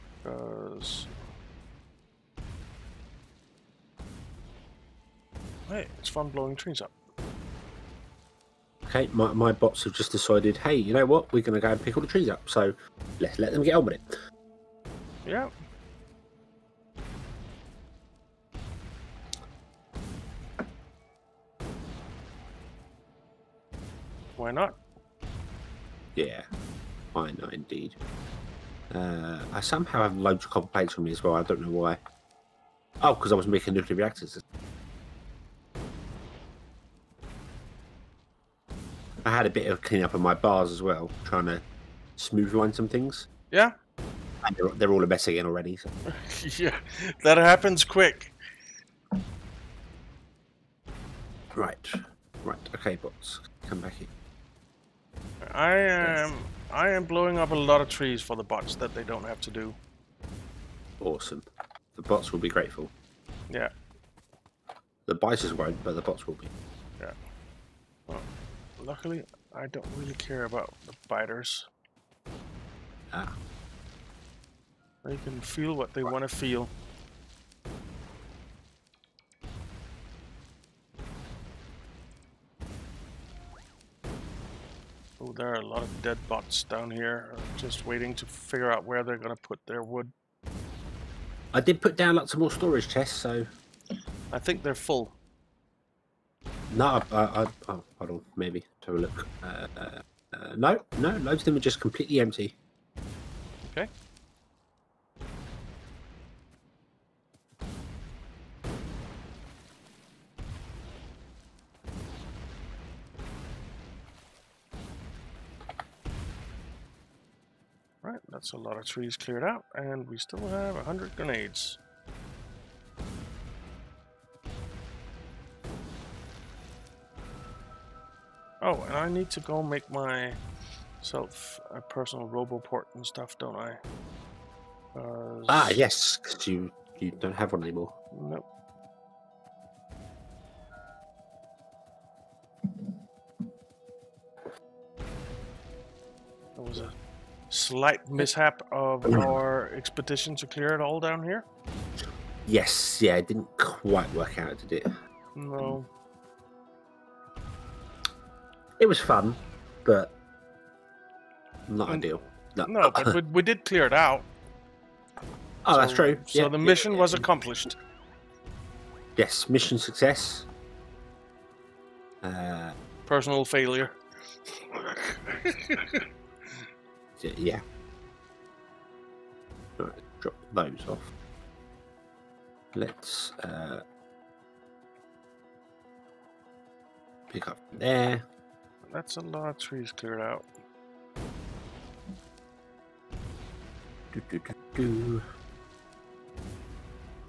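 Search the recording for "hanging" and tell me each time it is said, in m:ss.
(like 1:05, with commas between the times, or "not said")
not said.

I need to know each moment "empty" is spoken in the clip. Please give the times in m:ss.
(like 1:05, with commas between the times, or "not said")
1:42.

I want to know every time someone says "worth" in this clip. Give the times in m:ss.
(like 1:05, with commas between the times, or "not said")
not said.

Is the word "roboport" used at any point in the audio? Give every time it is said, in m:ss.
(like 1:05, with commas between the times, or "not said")
2:12.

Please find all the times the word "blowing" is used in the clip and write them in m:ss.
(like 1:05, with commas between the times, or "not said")
0:06, 0:57.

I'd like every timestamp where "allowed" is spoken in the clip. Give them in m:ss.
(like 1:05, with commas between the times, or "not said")
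not said.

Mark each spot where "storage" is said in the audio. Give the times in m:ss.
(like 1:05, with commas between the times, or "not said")
1:32.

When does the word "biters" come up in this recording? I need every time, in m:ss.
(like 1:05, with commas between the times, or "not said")
1:05, 1:11.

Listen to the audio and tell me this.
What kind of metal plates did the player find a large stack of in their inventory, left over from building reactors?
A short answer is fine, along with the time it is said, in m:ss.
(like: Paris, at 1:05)
copper, at 0:30.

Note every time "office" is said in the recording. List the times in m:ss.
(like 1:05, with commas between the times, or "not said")
not said.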